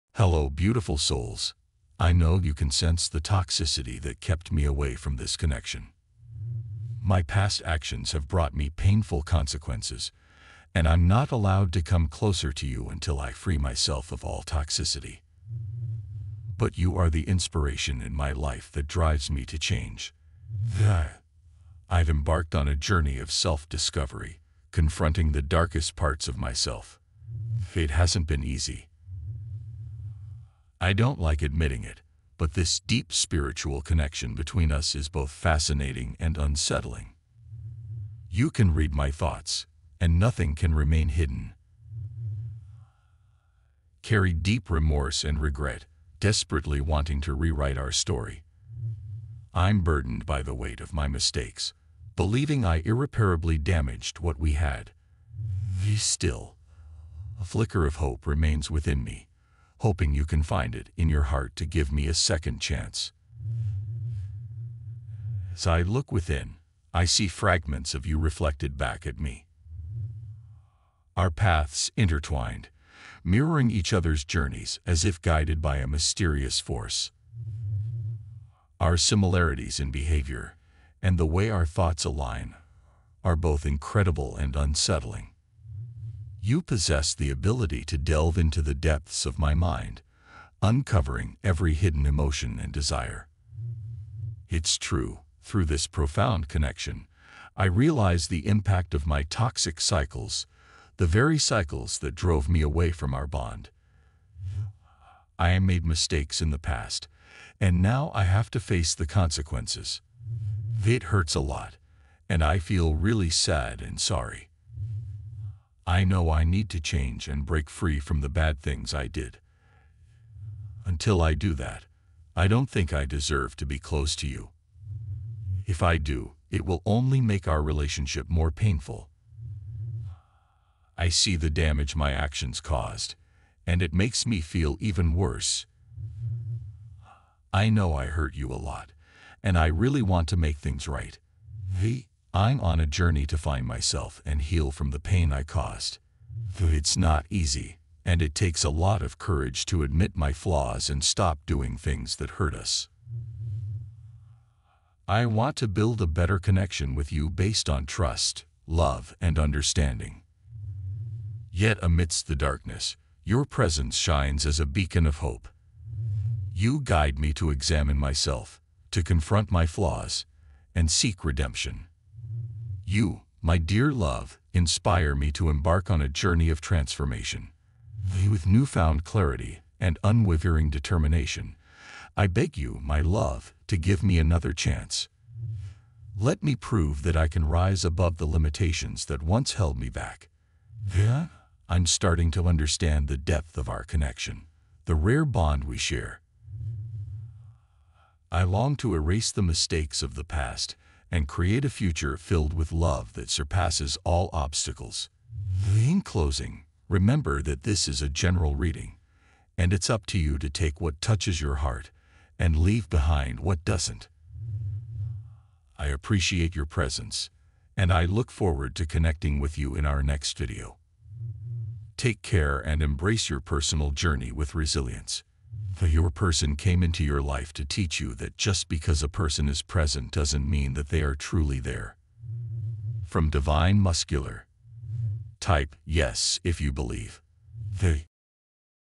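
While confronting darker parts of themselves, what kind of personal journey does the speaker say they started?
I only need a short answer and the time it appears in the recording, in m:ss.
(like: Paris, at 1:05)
self-discovery, at 0:23.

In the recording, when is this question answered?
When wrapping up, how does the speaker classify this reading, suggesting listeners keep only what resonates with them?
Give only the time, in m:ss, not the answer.
3:28.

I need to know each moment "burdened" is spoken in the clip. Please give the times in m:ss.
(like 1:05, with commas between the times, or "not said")
0:49.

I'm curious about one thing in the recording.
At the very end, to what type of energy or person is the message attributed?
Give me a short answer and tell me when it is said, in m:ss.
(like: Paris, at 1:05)
Divine Masculine, at 3:53.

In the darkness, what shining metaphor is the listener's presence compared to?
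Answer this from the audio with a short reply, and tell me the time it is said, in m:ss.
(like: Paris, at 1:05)
beacon of hope, at 2:44.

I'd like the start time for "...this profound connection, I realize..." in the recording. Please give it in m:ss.
1:35.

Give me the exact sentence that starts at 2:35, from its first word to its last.
I want to build a better connection with you based on trust, love, and understanding.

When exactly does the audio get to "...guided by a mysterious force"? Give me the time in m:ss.
1:15.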